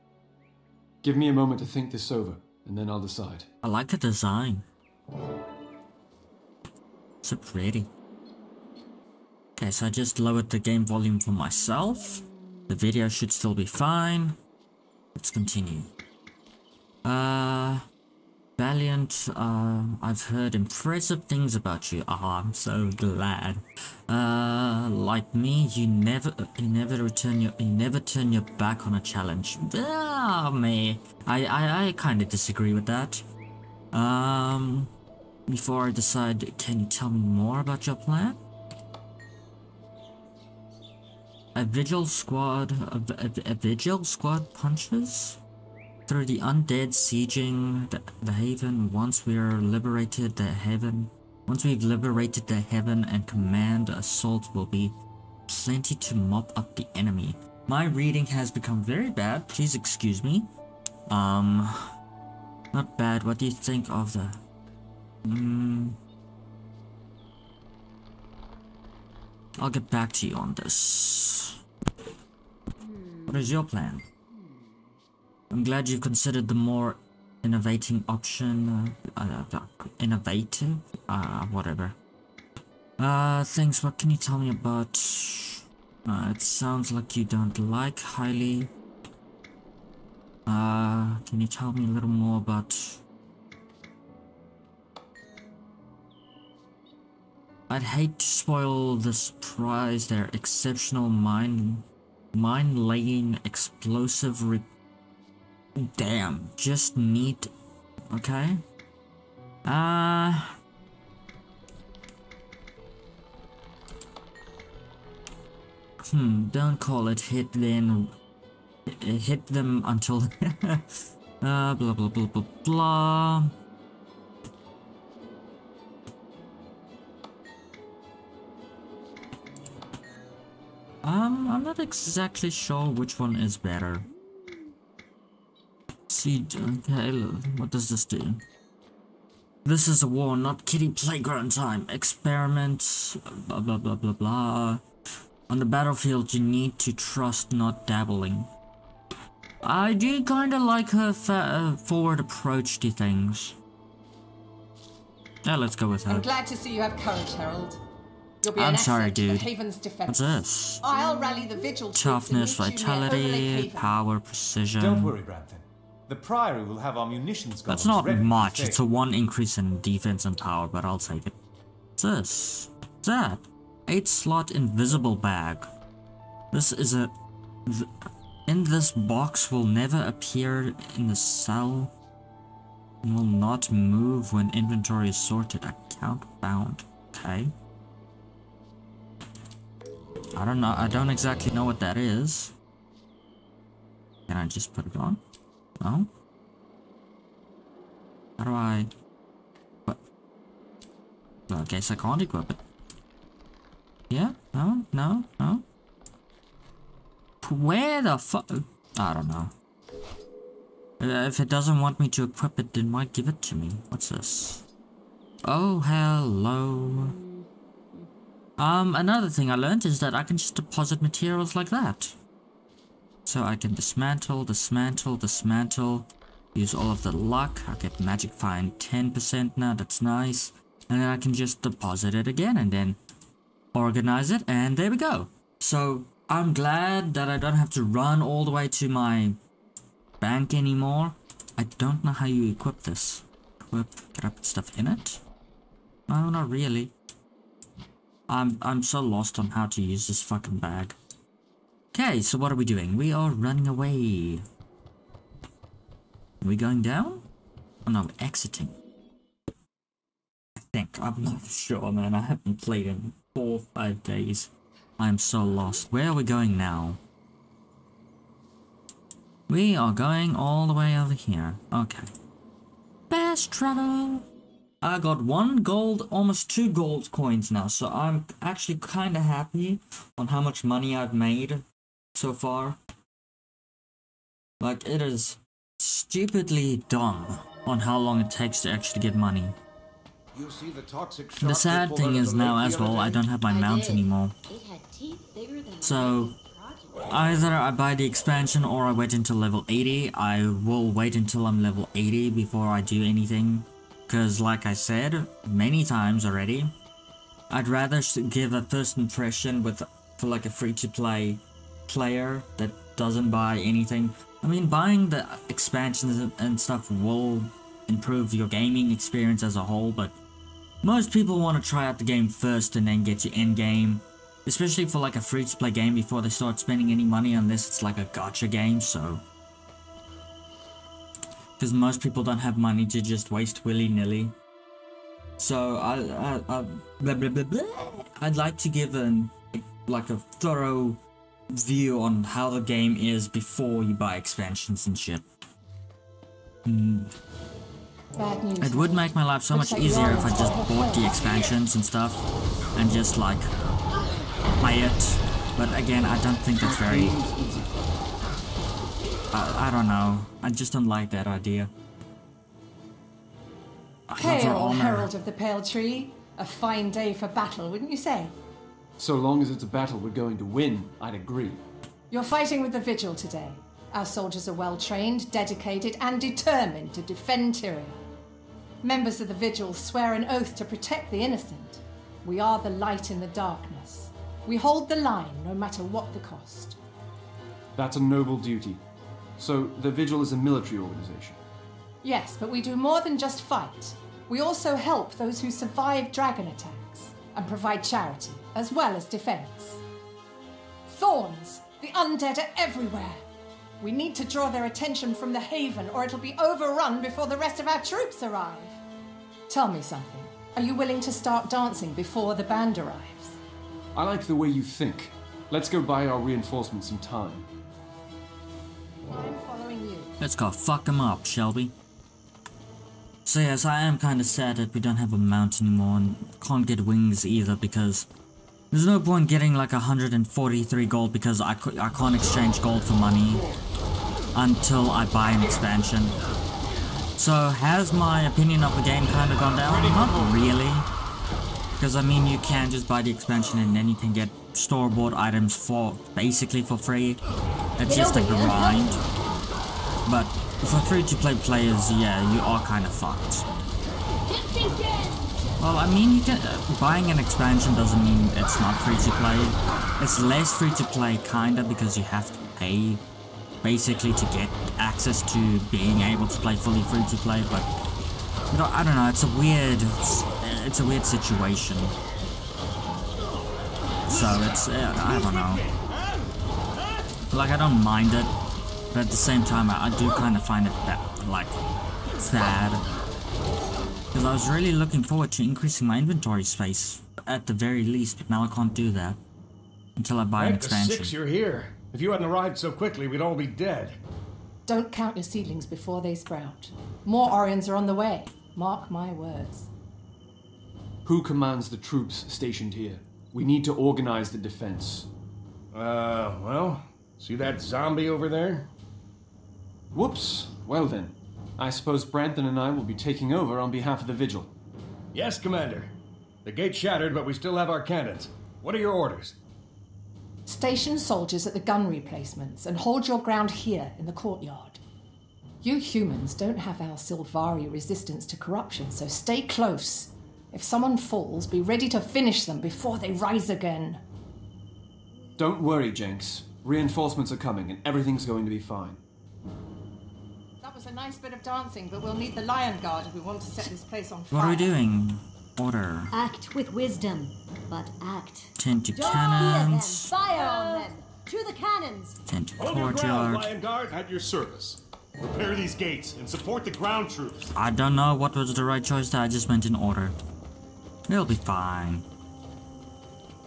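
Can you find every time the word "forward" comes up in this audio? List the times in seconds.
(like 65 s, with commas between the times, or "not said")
151 s, 485 s.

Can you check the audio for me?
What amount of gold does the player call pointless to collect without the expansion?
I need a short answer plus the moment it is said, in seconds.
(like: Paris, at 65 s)
143, at 429 s.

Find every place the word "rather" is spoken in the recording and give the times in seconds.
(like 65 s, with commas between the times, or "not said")
307 s.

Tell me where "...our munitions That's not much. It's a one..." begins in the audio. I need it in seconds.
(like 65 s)
166 s.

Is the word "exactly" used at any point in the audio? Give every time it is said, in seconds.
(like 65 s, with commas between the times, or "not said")
131 s, 191 s.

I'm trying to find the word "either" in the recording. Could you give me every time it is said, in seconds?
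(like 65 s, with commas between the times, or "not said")
297 s, 427 s.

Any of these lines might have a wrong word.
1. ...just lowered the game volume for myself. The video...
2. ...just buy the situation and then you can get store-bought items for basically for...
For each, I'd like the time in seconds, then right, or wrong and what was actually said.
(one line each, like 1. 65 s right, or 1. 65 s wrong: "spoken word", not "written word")
1. 9 s right
2. 442 s wrong: "expansion", not "situation".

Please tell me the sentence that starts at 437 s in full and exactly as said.
So has my opinion of the game kind of gone down?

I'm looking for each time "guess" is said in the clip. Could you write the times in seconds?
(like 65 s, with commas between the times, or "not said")
201 s.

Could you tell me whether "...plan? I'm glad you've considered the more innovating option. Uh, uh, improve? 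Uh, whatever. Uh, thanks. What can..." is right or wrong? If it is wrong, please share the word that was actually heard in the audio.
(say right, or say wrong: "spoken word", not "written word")
wrong: "innovative", not "improve".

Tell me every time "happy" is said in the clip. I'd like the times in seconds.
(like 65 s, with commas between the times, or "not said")
279 s.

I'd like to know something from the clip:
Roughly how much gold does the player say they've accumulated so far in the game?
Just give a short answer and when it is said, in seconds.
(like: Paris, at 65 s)
almost 2 gold, at 276 s.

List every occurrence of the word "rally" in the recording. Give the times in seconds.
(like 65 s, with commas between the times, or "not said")
161 s.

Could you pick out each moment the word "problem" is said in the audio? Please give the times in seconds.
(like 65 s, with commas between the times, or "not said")
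not said.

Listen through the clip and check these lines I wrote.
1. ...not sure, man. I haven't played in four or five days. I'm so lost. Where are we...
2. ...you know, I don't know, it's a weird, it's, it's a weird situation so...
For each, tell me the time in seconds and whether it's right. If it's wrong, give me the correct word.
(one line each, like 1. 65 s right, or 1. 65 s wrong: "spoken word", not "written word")
1. 261 s right
2. 468 s right.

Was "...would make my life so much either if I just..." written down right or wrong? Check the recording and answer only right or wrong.
wrong.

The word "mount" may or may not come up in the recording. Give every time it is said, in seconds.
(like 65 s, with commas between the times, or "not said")
293 s, 425 s.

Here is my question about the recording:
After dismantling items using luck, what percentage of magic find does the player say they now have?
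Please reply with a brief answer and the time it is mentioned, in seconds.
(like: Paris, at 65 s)
10%, at 228 s.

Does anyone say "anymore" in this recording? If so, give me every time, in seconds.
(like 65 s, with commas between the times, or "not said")
240 s, 293 s, 425 s.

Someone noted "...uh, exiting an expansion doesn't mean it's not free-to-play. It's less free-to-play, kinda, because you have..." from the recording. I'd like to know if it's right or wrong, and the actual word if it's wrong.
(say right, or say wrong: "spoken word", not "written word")
wrong: "buying", not "exiting".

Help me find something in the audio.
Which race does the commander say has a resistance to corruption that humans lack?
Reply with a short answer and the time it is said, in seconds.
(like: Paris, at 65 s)
Sylvari, at 526 s.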